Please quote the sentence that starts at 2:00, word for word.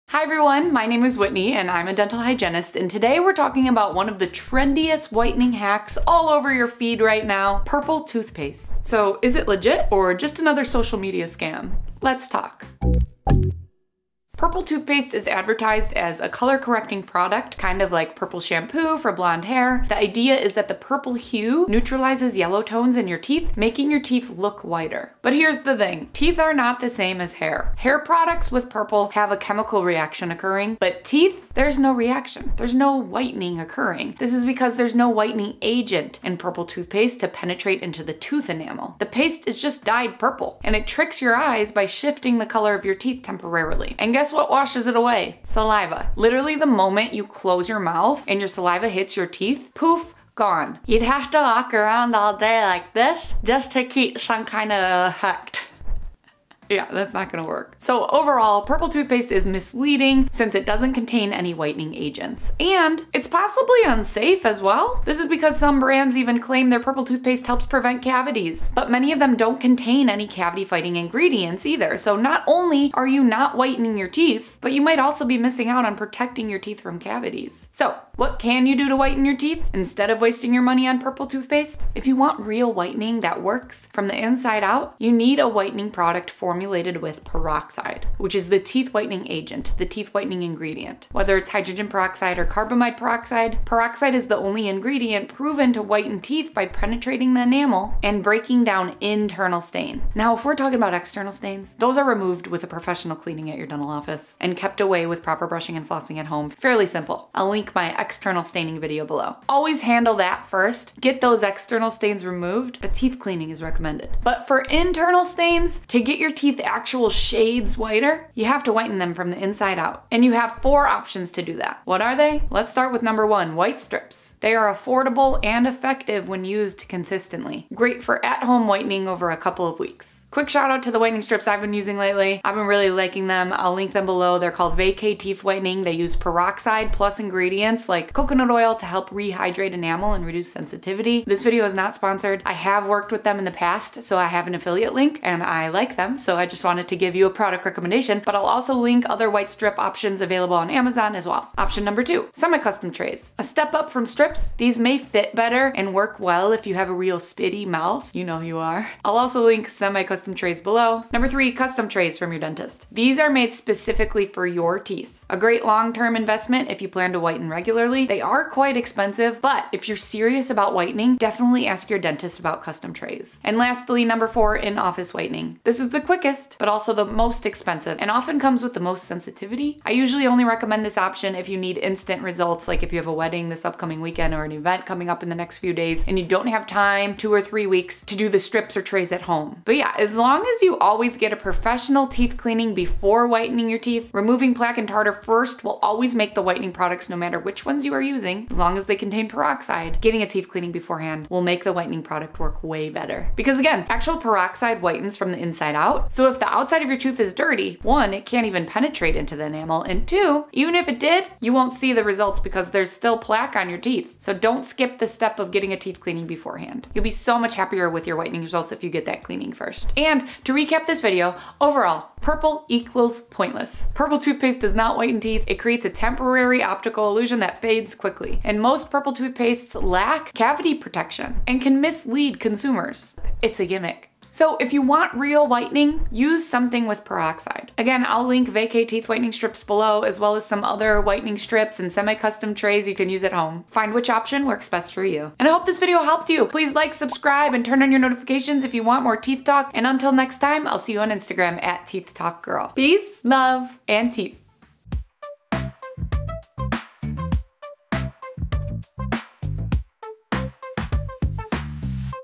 And you have four options to do that.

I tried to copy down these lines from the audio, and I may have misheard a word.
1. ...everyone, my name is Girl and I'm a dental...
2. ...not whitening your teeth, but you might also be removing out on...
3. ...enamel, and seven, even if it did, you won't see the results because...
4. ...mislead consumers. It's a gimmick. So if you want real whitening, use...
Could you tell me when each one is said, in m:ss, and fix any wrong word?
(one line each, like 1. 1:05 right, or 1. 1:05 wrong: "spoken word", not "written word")
1. 0:00 wrong: "Whitney", not "Girl"
2. 1:13 wrong: "missing", not "removing"
3. 3:29 wrong: "two", not "seven"
4. 3:51 right.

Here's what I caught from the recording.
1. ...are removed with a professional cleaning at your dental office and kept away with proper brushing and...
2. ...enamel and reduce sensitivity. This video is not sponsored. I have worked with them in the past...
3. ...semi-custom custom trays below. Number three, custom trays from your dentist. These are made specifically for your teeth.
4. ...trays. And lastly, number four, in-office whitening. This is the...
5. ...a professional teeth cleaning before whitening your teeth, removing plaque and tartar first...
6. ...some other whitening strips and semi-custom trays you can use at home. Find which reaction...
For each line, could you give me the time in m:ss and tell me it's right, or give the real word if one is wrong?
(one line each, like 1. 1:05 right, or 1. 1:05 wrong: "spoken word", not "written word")
1. 1:41 right
2. 2:19 right
3. 2:39 right
4. 2:52 right
5. 3:11 right
6. 4:00 wrong: "option", not "reaction".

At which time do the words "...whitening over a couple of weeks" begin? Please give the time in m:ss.
2:08.